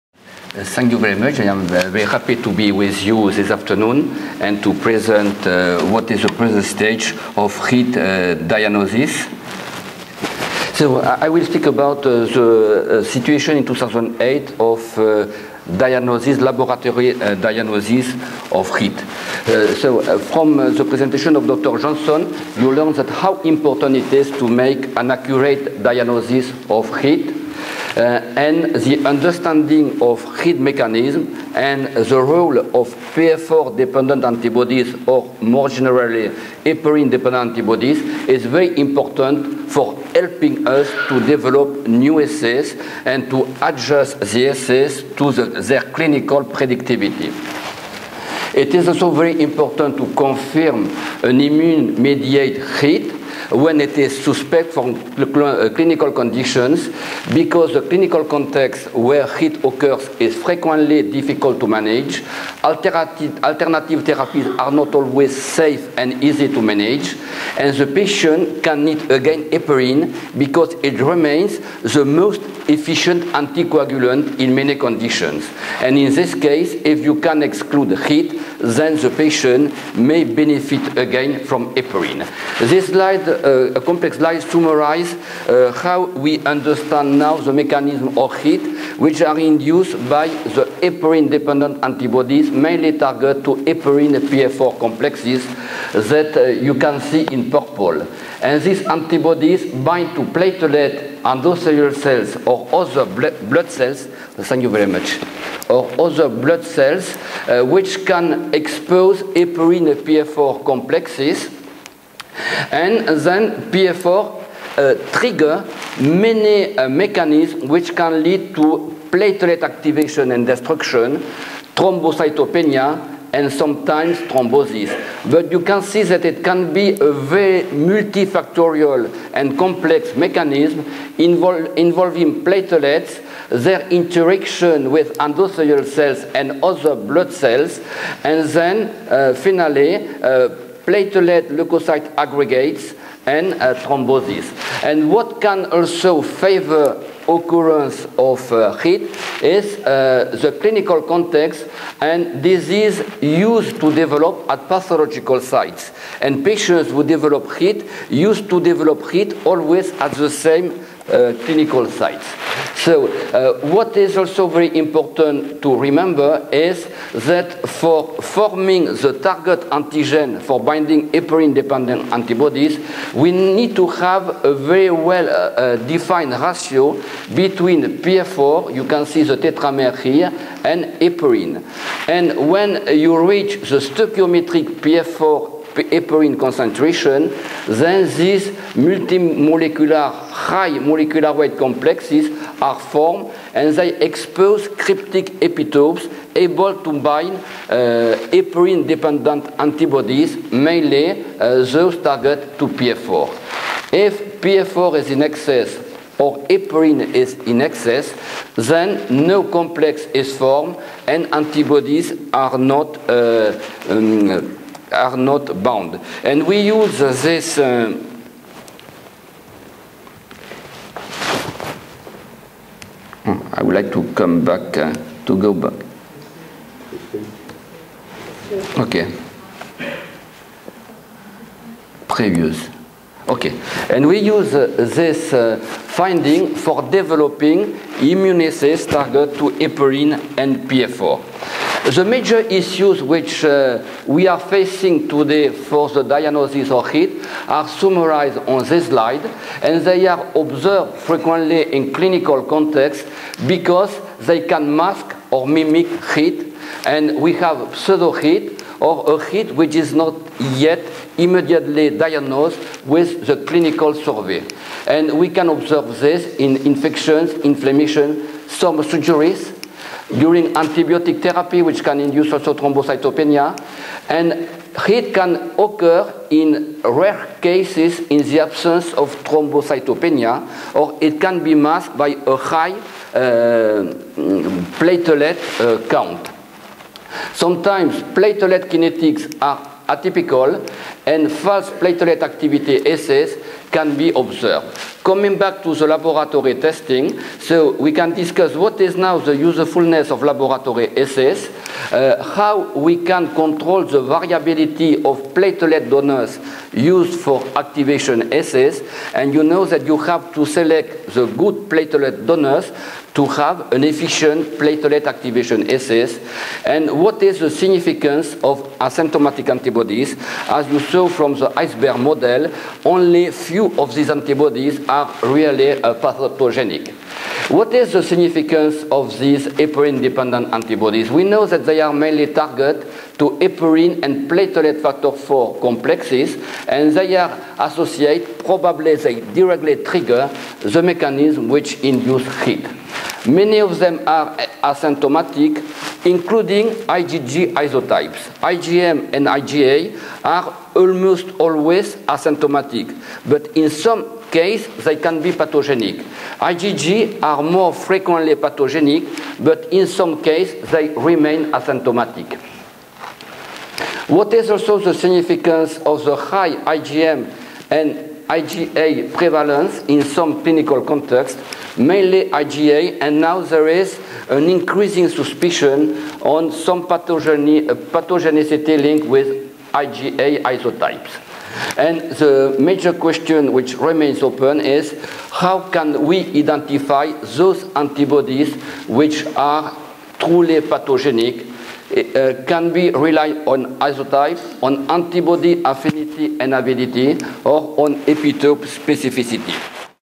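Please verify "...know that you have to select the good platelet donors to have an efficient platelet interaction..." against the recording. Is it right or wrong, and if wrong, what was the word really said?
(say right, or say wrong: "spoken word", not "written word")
wrong: "activation", not "interaction".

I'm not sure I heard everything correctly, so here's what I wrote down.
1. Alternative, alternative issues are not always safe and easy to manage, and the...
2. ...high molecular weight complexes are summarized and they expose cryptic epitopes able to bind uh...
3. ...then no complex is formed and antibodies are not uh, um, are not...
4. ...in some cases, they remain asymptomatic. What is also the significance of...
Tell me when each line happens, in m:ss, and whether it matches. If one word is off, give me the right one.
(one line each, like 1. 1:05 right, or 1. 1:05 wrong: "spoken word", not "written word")
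1. 1:02 wrong: "therapies", not "issues"
2. 3:10 wrong: "formed", not "summarized"
3. 3:28 right
4. 5:59 right.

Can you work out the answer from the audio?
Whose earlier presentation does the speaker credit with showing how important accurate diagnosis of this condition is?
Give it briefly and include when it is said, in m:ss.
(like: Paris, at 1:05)
Dr. Johnson, at 0:21.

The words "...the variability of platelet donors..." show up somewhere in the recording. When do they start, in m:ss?
5:03.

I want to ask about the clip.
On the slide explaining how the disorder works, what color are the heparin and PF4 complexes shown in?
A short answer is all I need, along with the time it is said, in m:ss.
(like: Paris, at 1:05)
Purple, at 1:37.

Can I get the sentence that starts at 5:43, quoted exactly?
Many of them are asymptomatic, including IgG isotypes.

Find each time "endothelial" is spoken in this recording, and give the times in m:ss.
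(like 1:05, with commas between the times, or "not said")
1:41, 2:15.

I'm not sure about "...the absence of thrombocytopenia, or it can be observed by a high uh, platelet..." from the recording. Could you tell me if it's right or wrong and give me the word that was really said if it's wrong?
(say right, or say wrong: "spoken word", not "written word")
wrong: "masked", not "observed".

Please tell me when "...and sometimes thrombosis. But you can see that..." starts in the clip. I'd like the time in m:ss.
2:03.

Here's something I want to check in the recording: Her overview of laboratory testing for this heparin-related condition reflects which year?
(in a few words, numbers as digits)
2008.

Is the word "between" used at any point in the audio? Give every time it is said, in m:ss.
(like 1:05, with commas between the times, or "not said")
2:57.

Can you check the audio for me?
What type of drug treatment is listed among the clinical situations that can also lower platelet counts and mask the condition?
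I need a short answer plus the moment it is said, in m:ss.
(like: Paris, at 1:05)
Antibiotic therapy, at 4:30.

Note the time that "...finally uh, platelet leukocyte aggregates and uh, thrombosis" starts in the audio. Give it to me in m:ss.
2:19.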